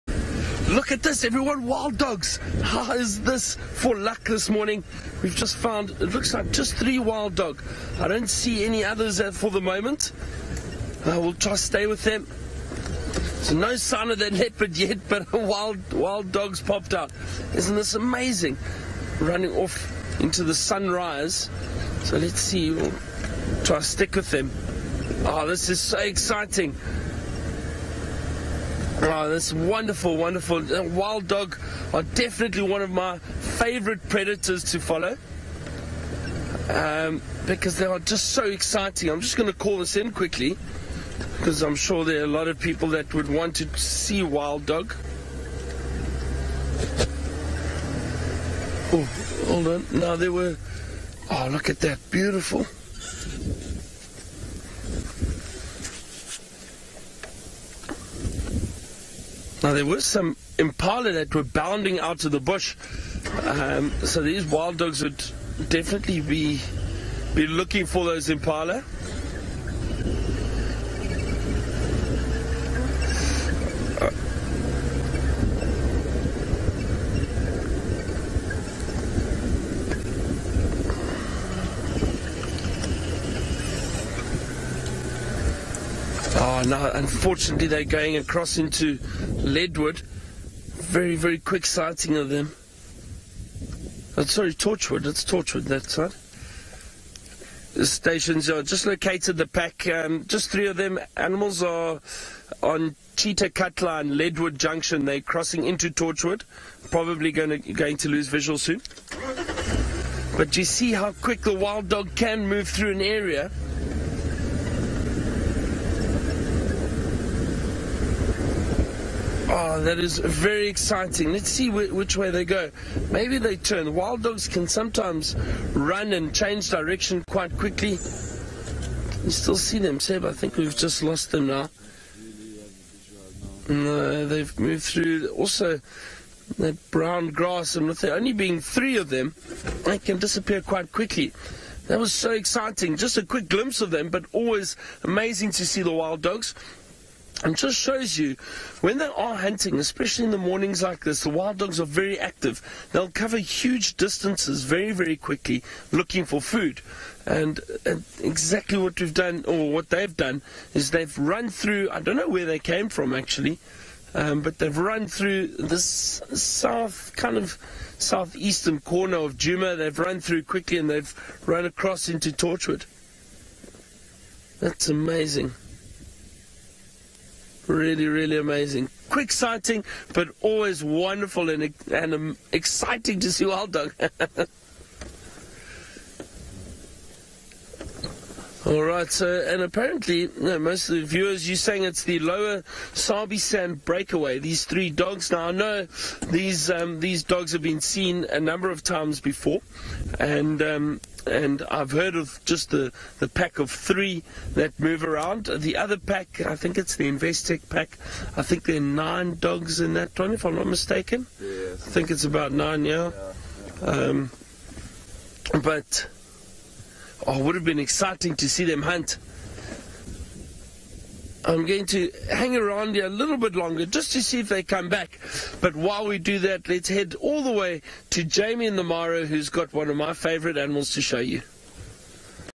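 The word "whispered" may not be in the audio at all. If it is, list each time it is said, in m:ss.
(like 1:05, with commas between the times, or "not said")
not said.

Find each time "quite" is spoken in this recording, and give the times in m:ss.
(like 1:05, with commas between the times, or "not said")
2:07, 2:20.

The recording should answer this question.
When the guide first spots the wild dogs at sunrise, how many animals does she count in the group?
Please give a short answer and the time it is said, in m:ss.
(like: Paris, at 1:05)
3, at 0:06.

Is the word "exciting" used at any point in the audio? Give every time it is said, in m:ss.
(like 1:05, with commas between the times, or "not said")
0:25, 0:38, 2:00, 2:22, 3:02, 3:37.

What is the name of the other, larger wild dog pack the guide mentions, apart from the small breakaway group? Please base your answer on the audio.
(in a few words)
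Investec pack.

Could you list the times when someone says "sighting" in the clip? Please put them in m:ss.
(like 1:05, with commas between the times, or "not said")
1:31, 2:59.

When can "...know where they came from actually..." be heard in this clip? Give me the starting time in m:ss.
2:42.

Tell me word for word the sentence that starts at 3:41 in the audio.
I'm going to hang around here a little bit longer just to see if they come back.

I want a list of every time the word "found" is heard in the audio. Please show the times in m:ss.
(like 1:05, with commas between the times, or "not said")
0:05.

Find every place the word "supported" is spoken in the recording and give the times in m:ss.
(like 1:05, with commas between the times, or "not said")
not said.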